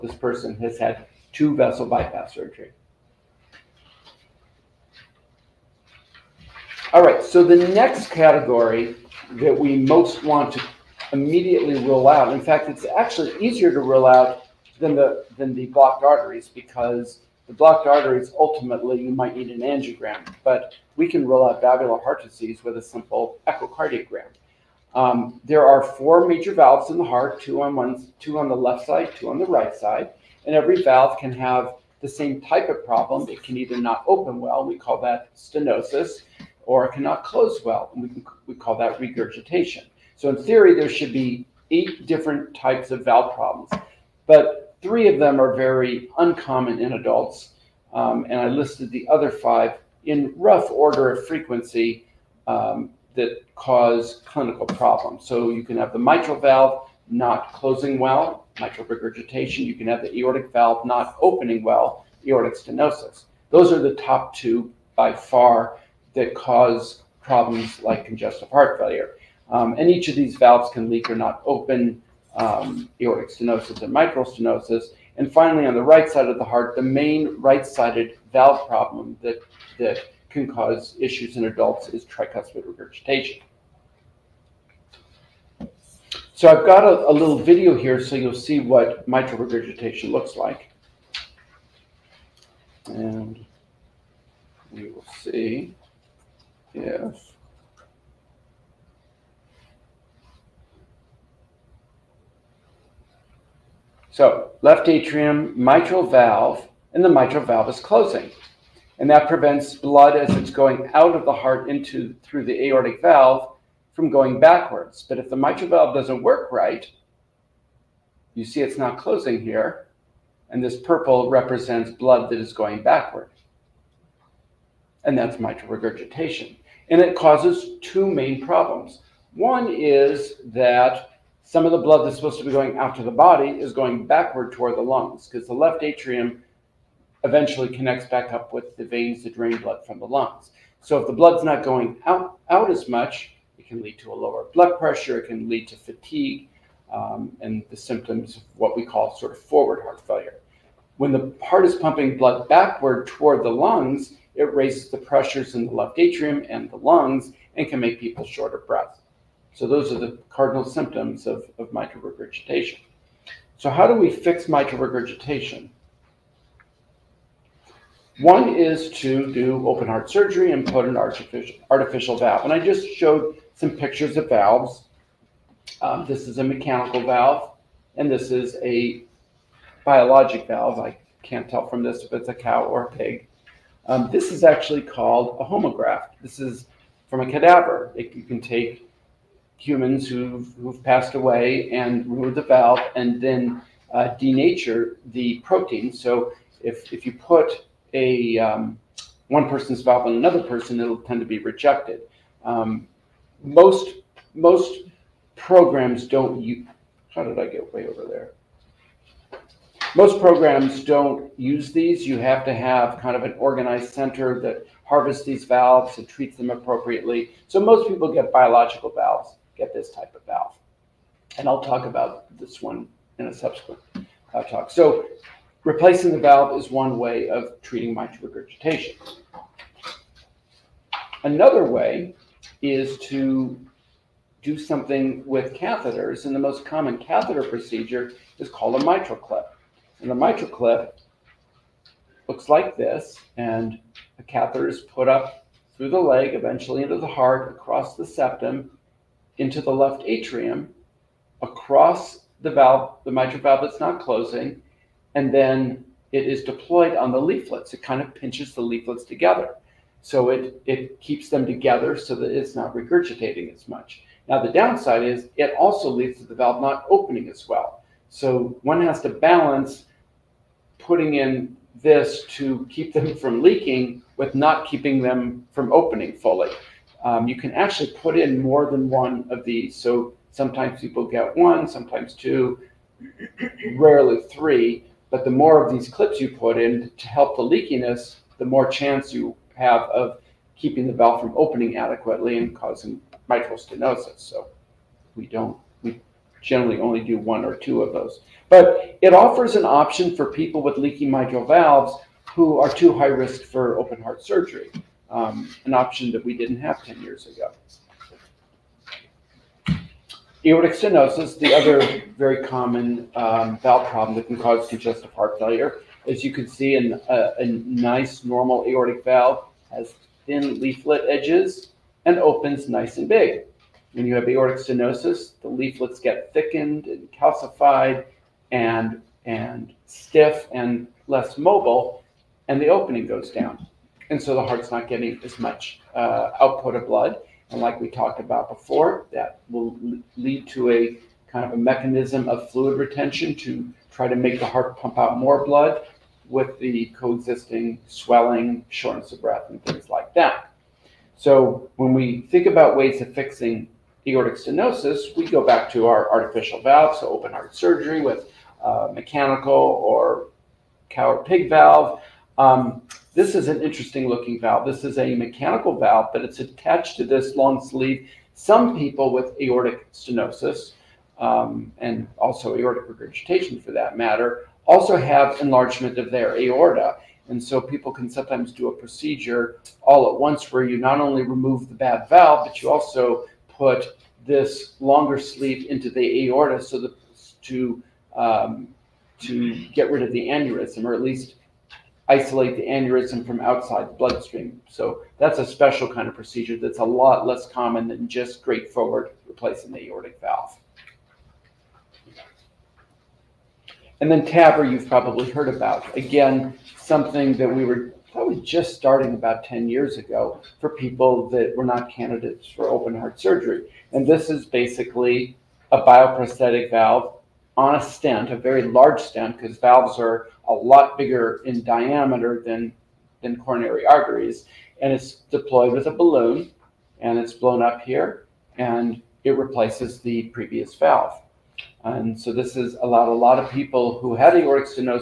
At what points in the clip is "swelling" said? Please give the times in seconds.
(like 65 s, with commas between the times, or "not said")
347 s.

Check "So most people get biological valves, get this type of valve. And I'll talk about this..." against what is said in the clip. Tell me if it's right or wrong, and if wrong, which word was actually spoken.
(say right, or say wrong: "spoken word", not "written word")
right.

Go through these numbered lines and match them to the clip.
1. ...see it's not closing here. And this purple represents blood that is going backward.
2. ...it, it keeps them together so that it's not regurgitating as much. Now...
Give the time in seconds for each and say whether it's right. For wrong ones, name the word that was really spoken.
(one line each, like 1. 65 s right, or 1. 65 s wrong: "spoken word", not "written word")
1. 118 s right
2. 260 s right.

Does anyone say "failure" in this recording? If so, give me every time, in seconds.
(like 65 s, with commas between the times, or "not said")
68 s, 150 s, 315 s.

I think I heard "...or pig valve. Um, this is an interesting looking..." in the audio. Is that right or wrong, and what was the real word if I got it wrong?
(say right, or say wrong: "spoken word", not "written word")
right.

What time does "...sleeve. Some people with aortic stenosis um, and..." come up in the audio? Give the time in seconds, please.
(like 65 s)
367 s.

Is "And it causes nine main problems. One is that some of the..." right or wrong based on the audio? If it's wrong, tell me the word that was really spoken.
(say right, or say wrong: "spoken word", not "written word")
wrong: "two", not "nine".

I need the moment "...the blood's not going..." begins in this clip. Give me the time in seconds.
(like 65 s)
141 s.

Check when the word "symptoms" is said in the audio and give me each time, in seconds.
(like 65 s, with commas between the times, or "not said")
147 s, 160 s.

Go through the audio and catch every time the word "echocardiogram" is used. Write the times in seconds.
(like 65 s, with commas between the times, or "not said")
23 s.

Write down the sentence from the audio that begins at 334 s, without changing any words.
And so the heart's not getting as much uh, output of blood.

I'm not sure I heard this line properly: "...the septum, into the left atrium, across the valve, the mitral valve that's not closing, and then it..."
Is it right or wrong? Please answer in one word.
right.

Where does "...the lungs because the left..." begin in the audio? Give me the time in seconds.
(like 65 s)
134 s.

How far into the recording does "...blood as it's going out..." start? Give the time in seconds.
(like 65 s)
109 s.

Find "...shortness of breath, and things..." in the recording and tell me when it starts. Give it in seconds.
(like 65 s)
348 s.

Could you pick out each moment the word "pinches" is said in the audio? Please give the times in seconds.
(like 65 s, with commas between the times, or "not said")
258 s.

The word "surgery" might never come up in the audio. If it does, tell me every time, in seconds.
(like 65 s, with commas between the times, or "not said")
2 s, 170 s, 304 s, 357 s, 413 s.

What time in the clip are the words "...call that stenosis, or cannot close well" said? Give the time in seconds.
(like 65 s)
34 s.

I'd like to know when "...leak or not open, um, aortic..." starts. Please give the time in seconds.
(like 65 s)
70 s.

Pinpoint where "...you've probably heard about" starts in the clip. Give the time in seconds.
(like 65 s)
404 s.